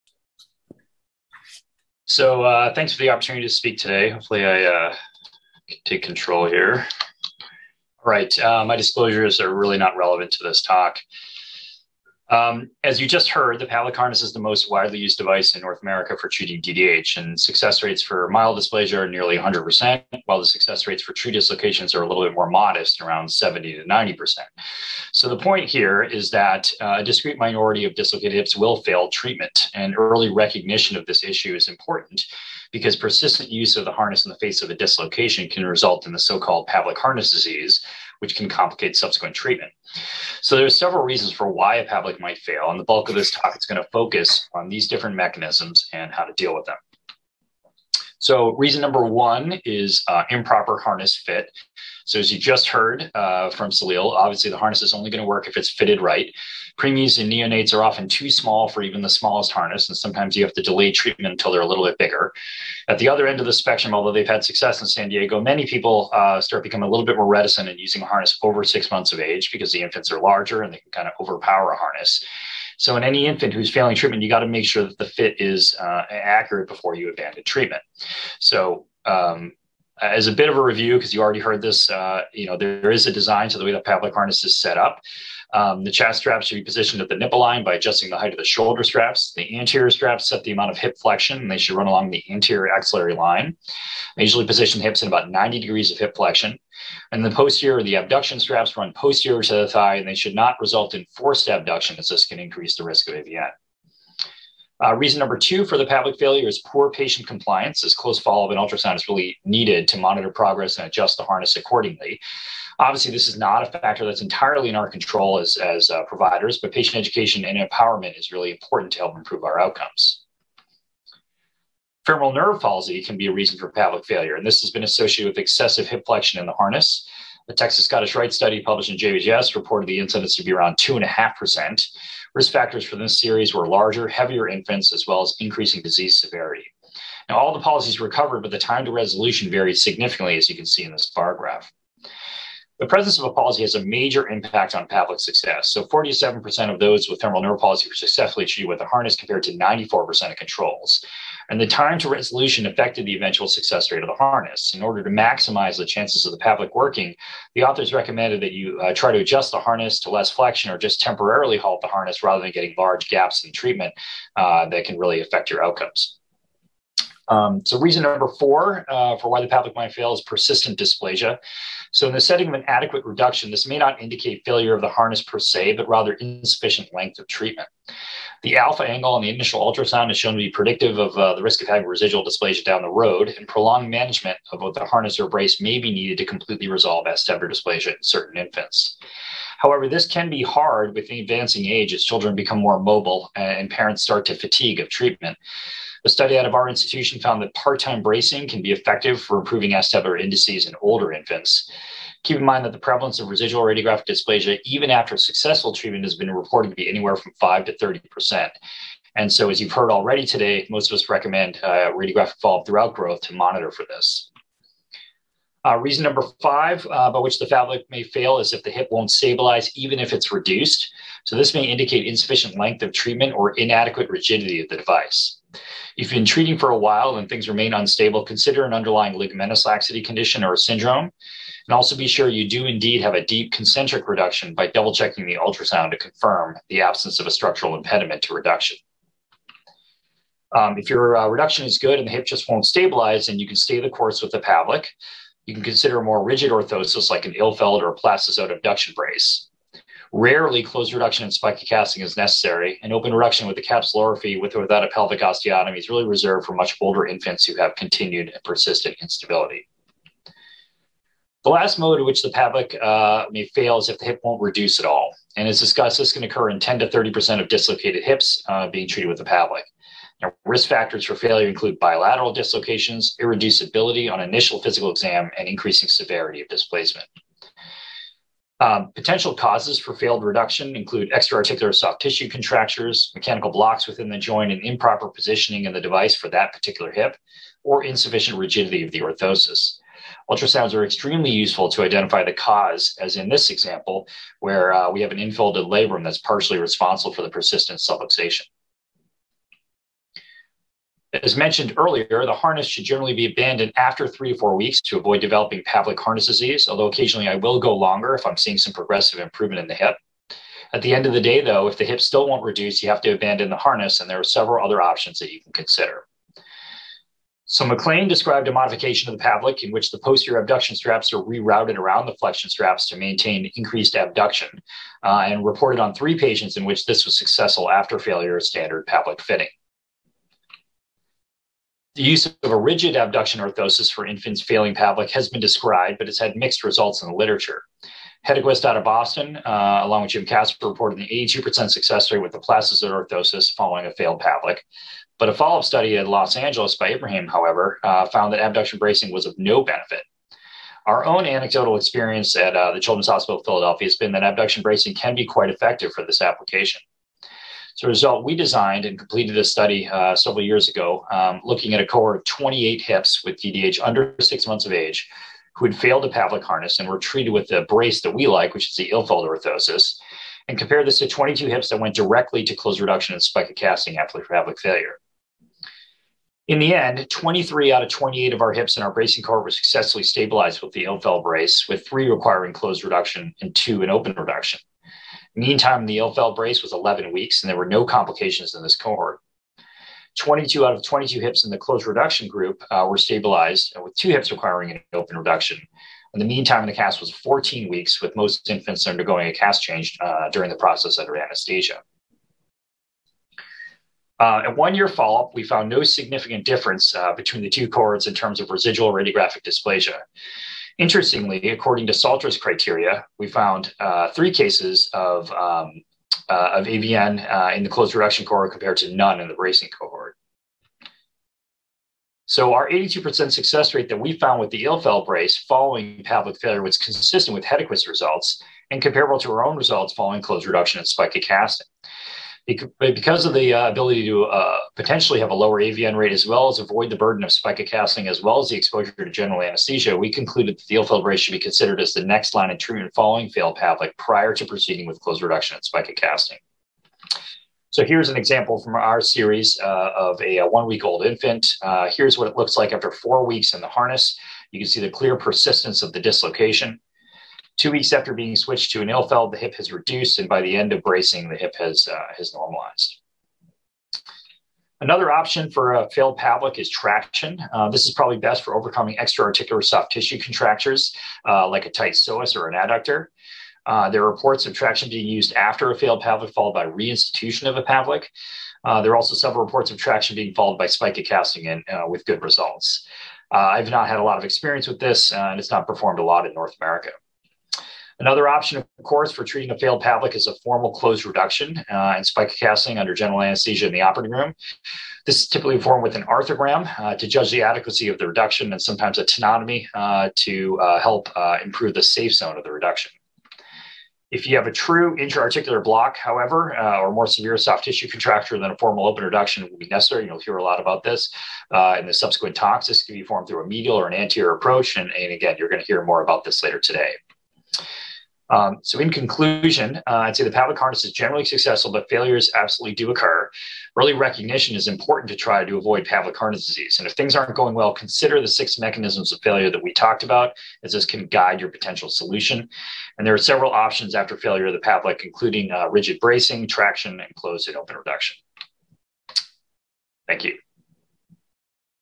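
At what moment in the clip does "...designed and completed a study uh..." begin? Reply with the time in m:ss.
5:58.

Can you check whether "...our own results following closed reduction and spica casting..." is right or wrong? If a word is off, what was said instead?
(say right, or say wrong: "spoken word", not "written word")
right.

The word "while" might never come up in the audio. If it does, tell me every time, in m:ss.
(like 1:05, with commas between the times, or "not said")
0:20, 3:46.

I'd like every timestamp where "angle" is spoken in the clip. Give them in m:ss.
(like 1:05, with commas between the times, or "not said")
2:58.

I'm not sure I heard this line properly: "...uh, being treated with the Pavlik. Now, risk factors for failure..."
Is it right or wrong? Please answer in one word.
right.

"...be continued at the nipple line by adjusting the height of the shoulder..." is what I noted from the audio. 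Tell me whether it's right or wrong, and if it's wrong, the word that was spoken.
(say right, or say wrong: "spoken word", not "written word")
wrong: "positioned", not "continued".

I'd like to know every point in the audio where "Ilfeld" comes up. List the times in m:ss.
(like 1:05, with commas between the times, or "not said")
4:07, 6:08, 6:20, 6:25, 7:04, 7:38.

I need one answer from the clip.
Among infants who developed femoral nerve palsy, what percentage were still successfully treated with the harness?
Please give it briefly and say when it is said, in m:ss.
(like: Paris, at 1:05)
47%, at 2:25.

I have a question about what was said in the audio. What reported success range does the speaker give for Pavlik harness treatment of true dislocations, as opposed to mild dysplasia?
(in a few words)
70 to 90%.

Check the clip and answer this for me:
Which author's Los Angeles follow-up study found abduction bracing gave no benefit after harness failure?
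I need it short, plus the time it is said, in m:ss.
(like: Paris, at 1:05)
Ibrahim, at 5:46.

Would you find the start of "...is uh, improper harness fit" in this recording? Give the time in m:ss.
0:49.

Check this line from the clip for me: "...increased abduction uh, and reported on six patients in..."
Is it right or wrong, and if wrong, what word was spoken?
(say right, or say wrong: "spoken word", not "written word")
wrong: "three", not "six".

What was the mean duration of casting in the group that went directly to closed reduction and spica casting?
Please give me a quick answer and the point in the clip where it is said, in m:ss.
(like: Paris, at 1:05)
14 weeks, at 6:37.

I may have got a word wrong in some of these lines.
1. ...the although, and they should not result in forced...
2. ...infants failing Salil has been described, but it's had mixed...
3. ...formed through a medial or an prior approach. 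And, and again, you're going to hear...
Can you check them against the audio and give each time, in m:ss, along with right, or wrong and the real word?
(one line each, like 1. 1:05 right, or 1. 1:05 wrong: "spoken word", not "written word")
1. 1:39 wrong: "thigh", not "although"
2. 5:34 wrong: "Pavlik", not "Salil"
3. 8:33 wrong: "anterior", not "prior".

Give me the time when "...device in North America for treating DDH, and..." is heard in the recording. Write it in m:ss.
0:15.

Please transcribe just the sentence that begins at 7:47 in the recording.
Uh, this is probably best for overcoming extraarticular soft tissue contractures uh, like a tight psoas or an adductor.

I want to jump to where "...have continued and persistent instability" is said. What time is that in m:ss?
4:17.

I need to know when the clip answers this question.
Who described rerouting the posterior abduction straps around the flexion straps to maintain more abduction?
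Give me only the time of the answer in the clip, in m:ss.
5:17.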